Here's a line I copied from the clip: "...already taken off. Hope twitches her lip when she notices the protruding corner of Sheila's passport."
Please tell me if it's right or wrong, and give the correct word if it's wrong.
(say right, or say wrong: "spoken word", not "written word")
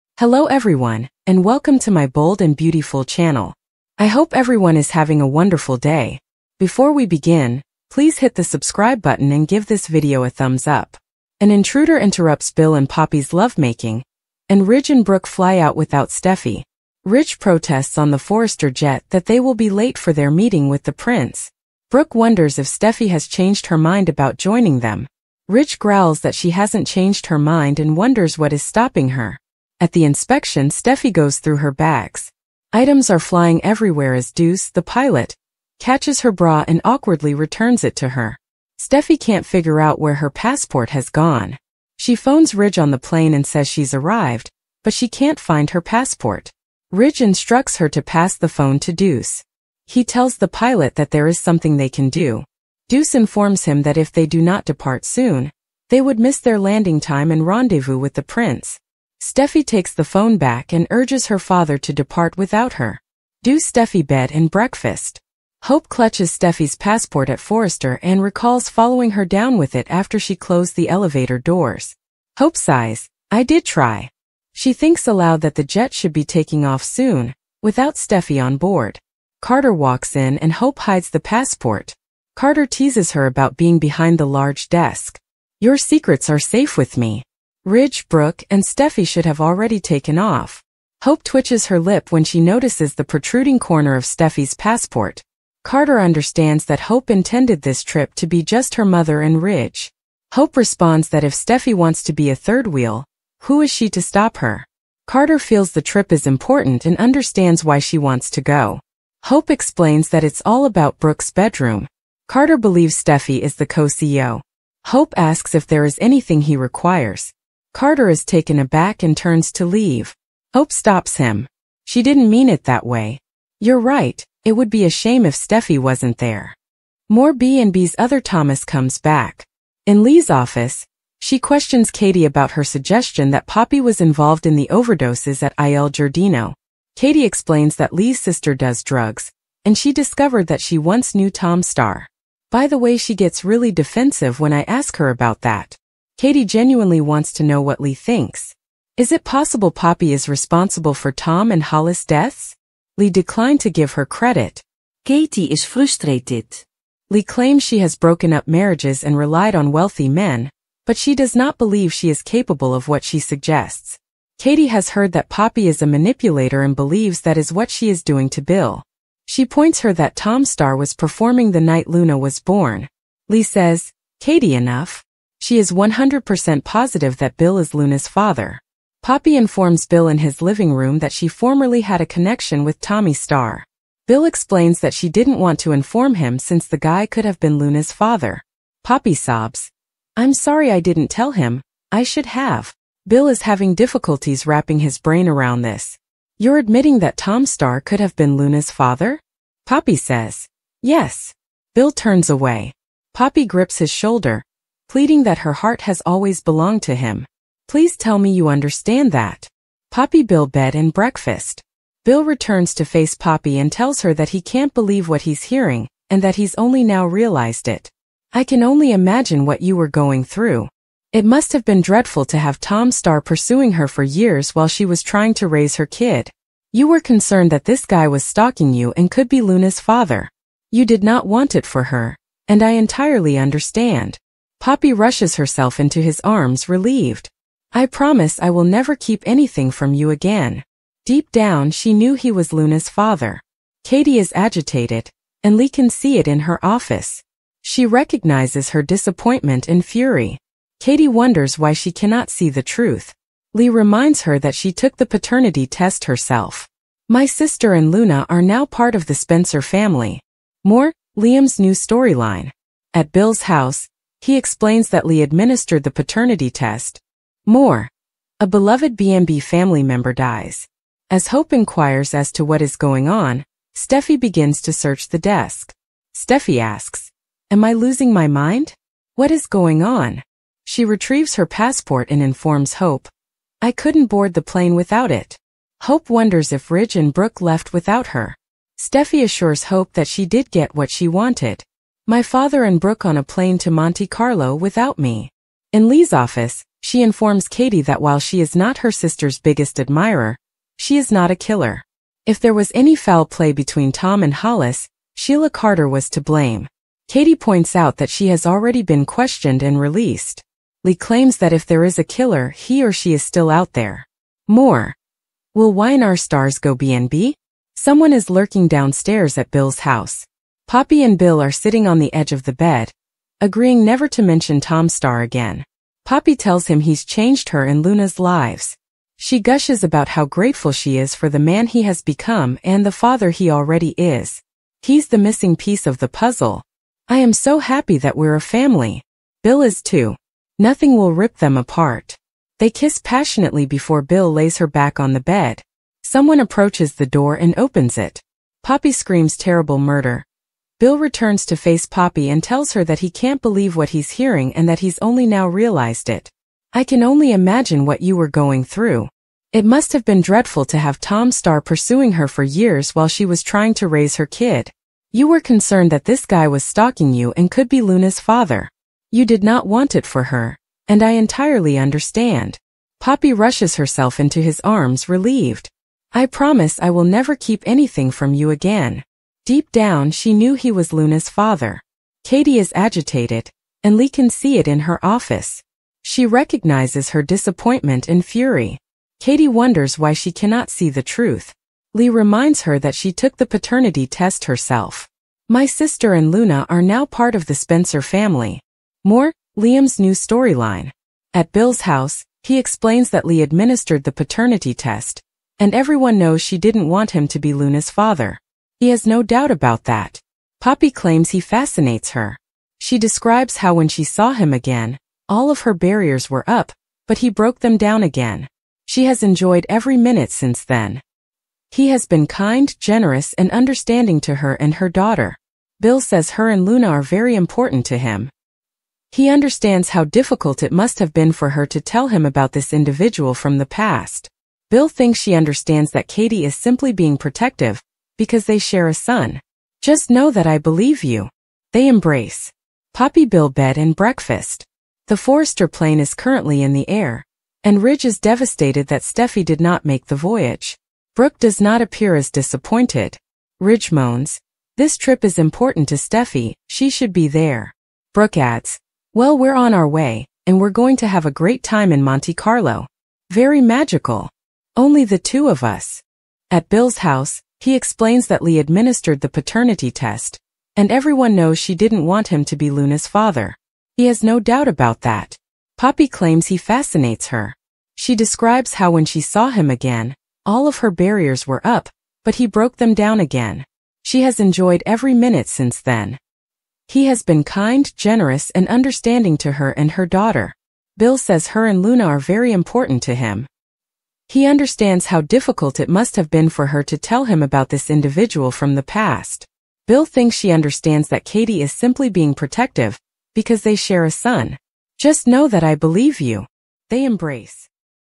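wrong: "Steffy", not "Sheila".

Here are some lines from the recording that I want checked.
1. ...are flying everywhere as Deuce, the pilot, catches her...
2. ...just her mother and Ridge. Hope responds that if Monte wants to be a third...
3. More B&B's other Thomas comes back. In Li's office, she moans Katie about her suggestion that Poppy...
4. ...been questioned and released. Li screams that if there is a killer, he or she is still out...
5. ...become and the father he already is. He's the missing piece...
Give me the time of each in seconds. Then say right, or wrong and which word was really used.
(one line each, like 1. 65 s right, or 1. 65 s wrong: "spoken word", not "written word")
1. 33 s right
2. 98 s wrong: "Steffy", not "Monte"
3. 127 s wrong: "questions", not "moans"
4. 308 s wrong: "claims", not "screams"
5. 332 s right.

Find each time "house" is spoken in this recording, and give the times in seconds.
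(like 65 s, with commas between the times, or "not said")
263 s, 319 s, 401 s, 466 s.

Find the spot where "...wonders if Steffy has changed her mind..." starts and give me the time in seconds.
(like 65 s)
22 s.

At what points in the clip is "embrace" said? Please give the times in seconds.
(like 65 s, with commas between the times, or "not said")
441 s, 507 s.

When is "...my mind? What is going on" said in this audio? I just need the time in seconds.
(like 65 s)
278 s.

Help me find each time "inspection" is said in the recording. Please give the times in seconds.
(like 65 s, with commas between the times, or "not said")
30 s.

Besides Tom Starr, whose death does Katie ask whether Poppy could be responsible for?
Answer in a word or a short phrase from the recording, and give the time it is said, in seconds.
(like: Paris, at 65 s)
Hollis, at 151 s.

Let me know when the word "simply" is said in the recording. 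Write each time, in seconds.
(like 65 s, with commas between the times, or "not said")
436 s, 501 s.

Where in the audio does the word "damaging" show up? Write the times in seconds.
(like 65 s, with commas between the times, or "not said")
not said.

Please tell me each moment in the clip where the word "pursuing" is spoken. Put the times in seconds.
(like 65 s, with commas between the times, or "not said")
223 s, 361 s.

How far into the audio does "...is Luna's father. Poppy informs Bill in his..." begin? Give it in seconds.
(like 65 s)
177 s.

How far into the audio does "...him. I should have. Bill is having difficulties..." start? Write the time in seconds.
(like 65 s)
191 s.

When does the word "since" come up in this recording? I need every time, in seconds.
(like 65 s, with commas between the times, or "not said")
186 s, 420 s, 485 s.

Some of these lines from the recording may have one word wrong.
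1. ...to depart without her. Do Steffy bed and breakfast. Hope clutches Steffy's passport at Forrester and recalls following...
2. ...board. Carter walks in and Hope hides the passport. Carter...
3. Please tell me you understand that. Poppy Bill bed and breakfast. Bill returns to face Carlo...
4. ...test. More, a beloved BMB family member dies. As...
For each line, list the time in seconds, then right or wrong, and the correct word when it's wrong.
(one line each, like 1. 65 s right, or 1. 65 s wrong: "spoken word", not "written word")
1. 61 s right
2. 78 s right
3. 207 s wrong: "Poppy", not "Carlo"
4. 266 s right.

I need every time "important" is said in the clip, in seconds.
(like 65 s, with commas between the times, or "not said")
106 s, 427 s, 455 s, 492 s.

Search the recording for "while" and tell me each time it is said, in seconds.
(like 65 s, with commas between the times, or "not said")
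224 s, 298 s, 362 s.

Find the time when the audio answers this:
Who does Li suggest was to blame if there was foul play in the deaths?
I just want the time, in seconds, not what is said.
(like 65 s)
305 s.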